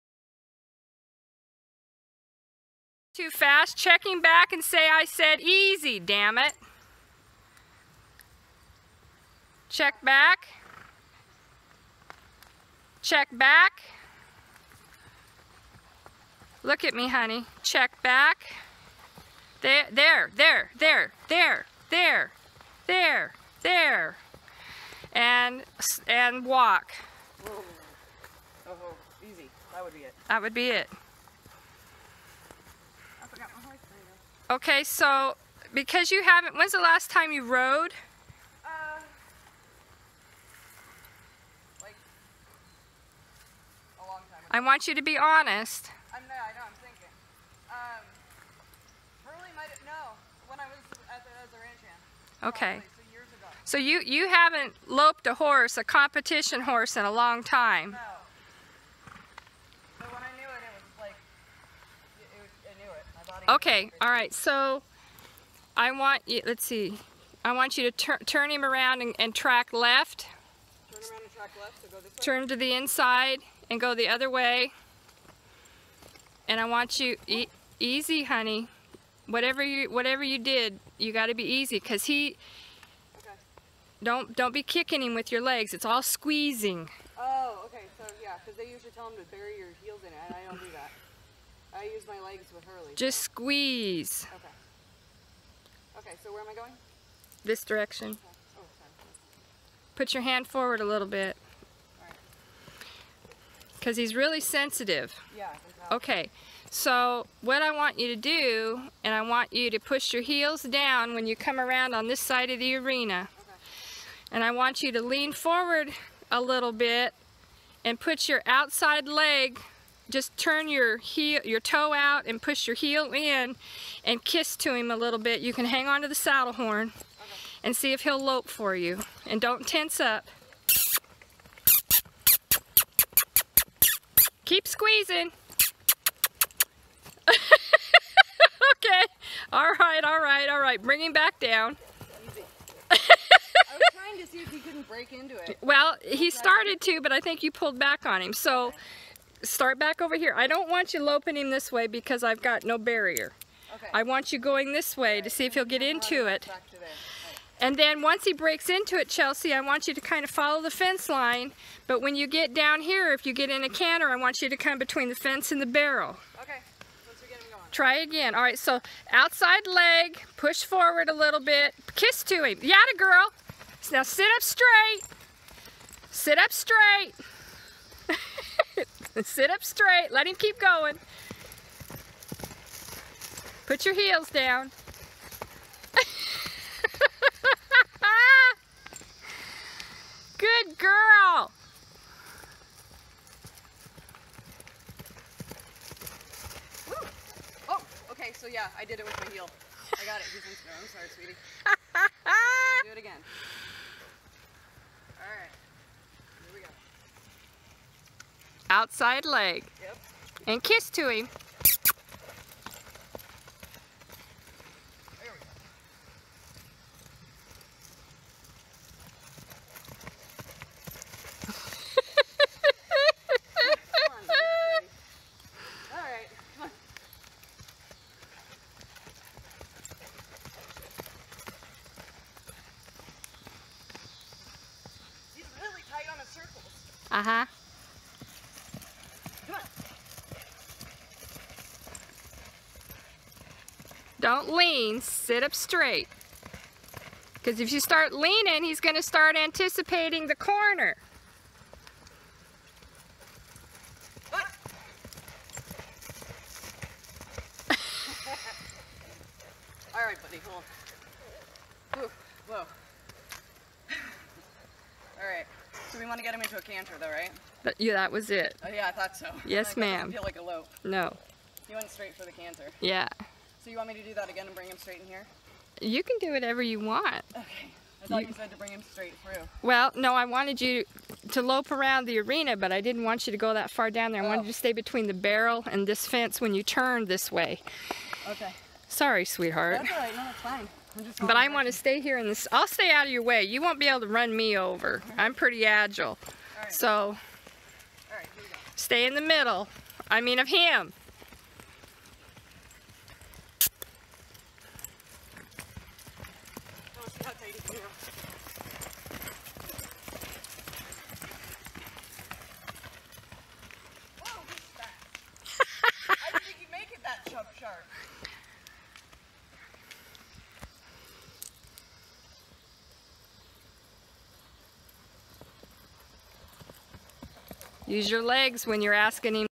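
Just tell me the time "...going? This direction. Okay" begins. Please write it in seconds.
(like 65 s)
96 s.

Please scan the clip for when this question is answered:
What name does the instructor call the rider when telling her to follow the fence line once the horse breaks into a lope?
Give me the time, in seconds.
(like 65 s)
159 s.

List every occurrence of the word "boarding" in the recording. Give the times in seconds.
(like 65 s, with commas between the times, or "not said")
not said.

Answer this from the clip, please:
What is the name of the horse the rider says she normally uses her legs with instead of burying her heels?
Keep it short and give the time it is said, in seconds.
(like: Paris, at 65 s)
Hurley, at 92 s.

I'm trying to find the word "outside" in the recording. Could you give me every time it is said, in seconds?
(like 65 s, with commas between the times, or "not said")
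118 s, 169 s.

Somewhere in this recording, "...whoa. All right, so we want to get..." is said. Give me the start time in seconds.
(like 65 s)
262 s.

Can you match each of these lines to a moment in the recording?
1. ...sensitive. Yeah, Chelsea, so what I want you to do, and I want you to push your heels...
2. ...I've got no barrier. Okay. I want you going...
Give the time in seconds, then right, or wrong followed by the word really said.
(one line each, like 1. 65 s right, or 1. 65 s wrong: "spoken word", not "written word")
1. 104 s wrong: "Okay", not "Chelsea"
2. 152 s right.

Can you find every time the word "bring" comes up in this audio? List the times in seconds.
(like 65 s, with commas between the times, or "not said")
140 s, 274 s, 278 s.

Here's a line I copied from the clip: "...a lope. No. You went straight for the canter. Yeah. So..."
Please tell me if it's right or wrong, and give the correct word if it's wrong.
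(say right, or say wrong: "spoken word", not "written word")
right.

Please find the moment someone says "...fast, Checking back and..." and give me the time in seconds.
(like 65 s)
3 s.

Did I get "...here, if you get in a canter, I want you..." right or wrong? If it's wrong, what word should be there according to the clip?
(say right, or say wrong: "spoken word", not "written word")
right.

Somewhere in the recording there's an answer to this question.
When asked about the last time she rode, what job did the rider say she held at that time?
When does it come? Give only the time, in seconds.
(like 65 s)
51 s.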